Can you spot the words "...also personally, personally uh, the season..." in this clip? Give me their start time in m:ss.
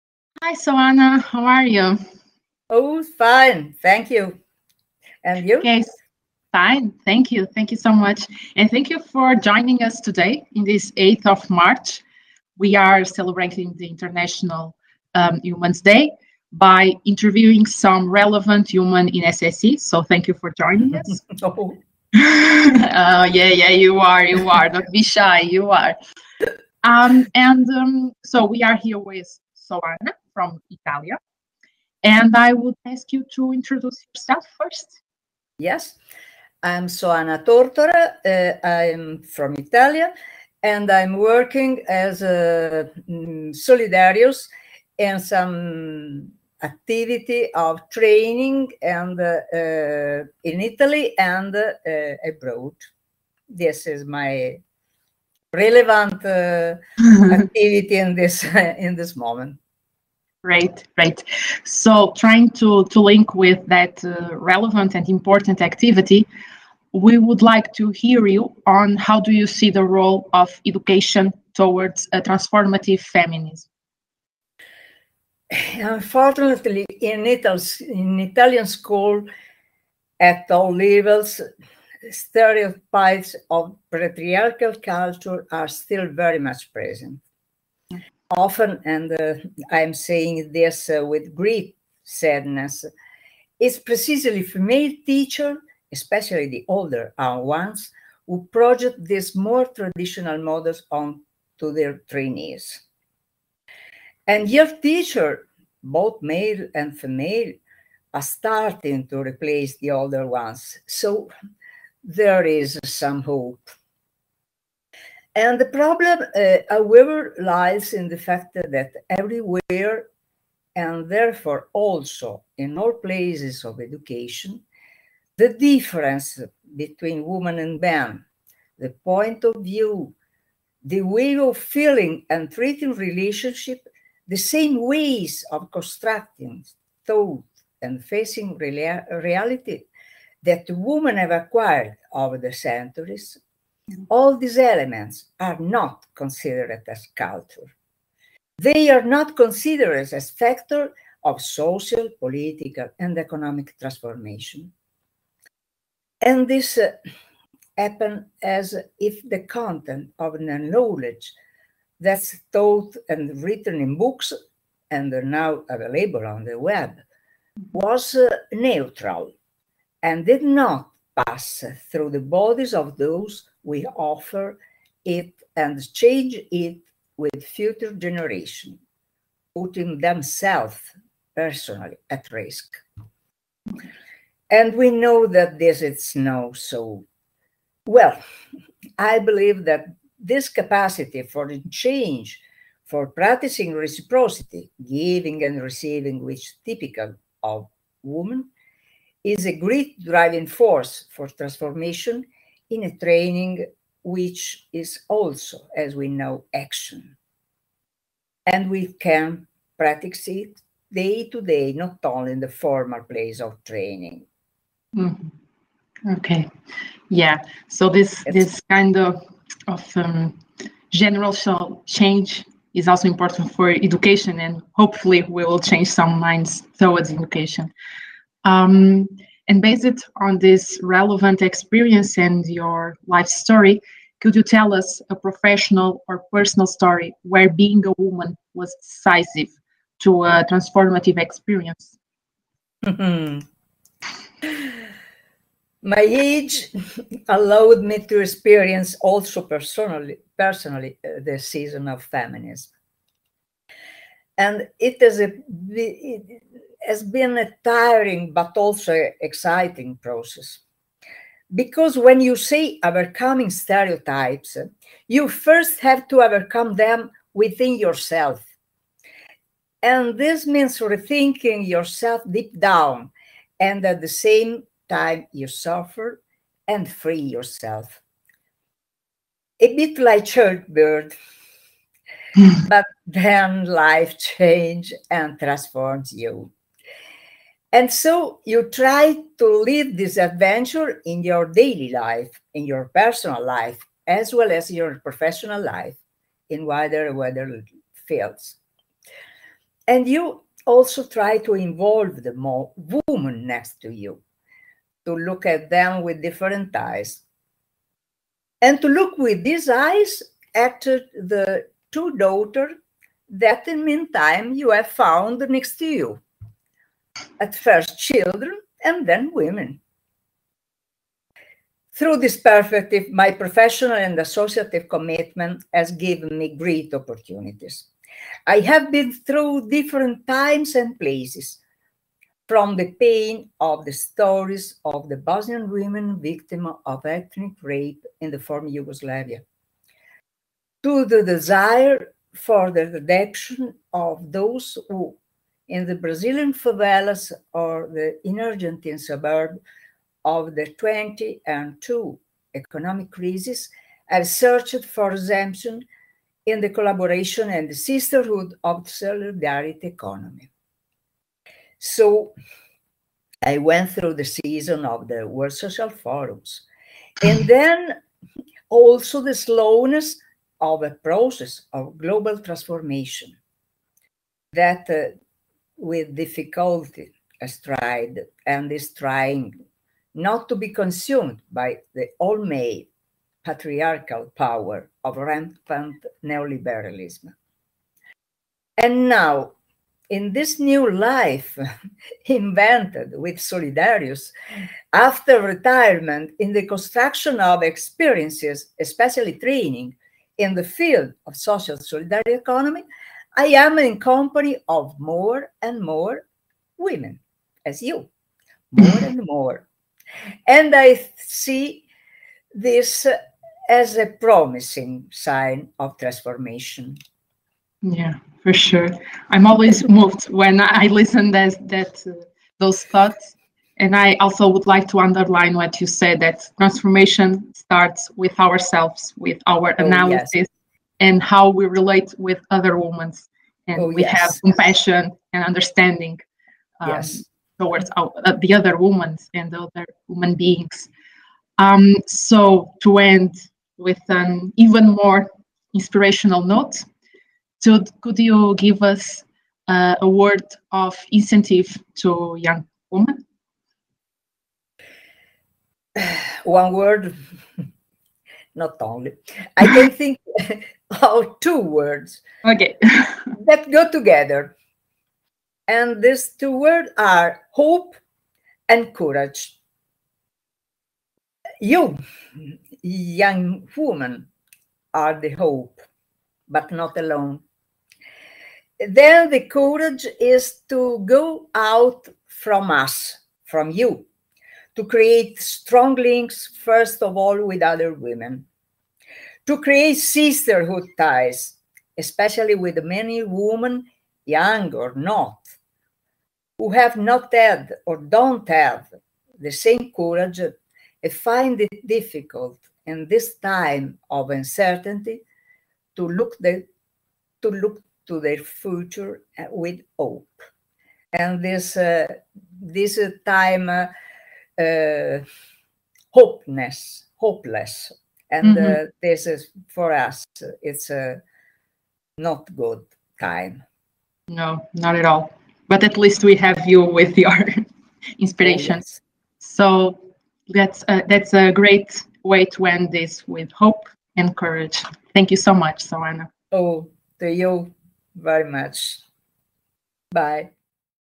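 4:09.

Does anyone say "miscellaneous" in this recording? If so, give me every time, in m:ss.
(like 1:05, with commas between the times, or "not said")
not said.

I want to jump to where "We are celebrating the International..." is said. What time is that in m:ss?
0:12.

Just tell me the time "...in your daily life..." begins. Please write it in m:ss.
4:51.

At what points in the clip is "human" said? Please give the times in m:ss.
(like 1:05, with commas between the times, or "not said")
0:18, 7:20.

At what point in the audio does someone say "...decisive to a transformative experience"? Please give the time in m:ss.
3:58.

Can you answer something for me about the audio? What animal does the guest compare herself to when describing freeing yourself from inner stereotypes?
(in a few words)
Bird.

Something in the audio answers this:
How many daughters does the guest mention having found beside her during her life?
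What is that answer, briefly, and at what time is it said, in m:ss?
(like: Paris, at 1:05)
2, at 5:11.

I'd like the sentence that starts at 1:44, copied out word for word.
And your teacher, both male and female, are starting to replace the older ones.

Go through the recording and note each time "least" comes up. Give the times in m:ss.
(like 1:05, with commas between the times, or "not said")
8:45.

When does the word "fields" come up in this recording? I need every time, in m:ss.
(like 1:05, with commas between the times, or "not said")
4:58, 6:40.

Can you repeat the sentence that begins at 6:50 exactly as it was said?
And I see this as a promising sign of transformation.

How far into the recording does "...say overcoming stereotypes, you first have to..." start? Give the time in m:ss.
4:22.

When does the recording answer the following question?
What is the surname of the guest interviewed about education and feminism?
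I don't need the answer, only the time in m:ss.
0:37.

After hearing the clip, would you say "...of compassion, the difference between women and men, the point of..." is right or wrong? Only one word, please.
wrong.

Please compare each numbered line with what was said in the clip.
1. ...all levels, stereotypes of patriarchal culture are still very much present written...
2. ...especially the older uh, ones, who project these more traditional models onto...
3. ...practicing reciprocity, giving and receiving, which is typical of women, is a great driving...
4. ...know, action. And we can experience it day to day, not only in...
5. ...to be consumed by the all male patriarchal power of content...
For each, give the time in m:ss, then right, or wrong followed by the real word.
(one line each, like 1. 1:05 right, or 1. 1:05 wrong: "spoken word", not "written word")
1. 1:20 wrong: "often", not "written"
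2. 1:35 right
3. 3:13 right
4. 3:26 wrong: "practice", not "experience"
5. 6:20 wrong: "rampant", not "content".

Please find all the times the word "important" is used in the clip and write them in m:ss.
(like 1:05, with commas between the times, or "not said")
1:05, 3:43.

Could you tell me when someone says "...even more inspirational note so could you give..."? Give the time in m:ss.
7:24.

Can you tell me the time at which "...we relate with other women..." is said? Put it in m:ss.
7:11.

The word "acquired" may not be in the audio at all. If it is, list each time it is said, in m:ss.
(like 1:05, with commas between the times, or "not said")
2:21.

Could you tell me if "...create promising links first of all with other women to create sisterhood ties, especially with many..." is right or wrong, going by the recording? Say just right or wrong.
wrong.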